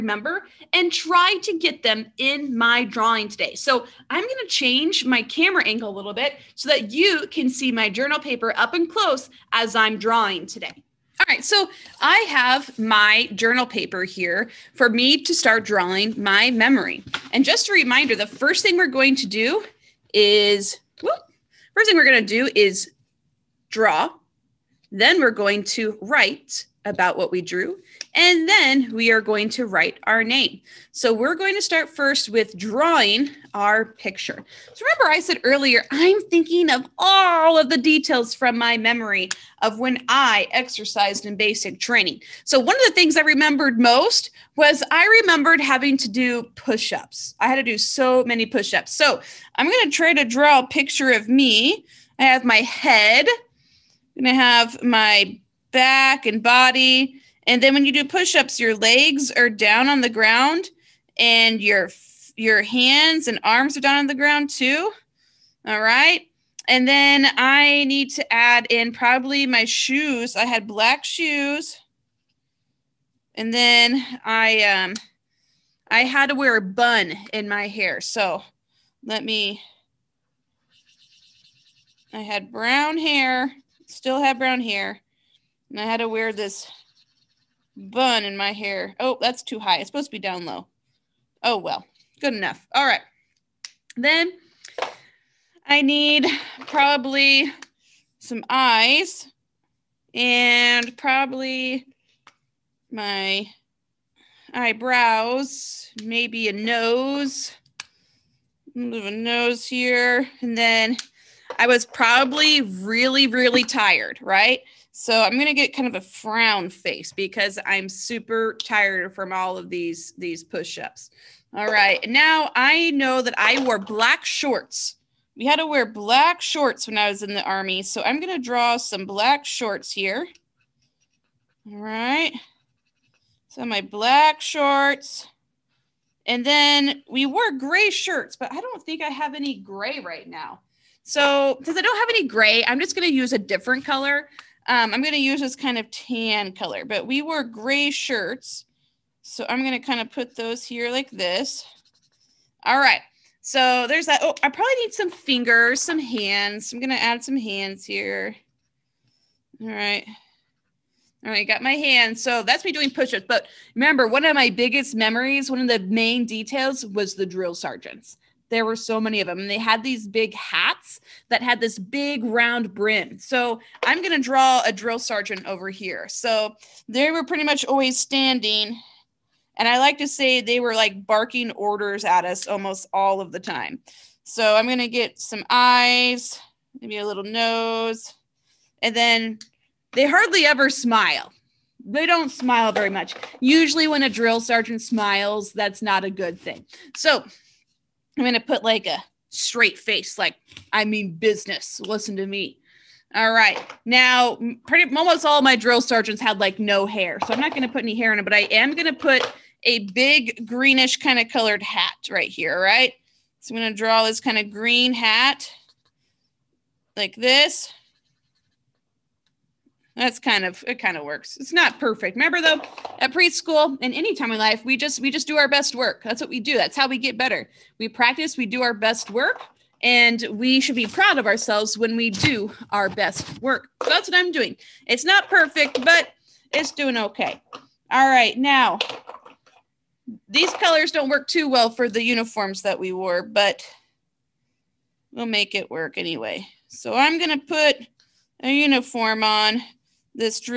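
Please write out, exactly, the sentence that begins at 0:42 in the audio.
So one of the things I remembered most was I remembered having to do push-ups.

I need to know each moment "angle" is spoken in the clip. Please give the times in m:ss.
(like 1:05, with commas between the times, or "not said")
0:05.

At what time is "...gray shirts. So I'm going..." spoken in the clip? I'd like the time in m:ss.
2:27.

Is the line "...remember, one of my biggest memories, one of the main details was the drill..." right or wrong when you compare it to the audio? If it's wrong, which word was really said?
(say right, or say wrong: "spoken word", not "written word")
right.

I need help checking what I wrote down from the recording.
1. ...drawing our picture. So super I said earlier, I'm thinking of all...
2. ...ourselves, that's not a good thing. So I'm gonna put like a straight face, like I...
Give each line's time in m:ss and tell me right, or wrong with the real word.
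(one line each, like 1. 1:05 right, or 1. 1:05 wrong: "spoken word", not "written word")
1. 0:32 wrong: "remember", not "super"
2. 3:14 wrong: "smiles", not "ourselves".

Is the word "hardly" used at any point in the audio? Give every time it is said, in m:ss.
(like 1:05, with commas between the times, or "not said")
3:10.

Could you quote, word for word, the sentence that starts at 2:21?
So since I don't have any gray, I'm just going to use a different color.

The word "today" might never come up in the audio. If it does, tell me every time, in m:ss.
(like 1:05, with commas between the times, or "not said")
0:03, 0:10.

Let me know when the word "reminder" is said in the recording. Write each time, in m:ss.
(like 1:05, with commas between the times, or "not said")
0:17.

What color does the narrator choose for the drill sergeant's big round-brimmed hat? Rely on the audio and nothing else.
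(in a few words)
Green.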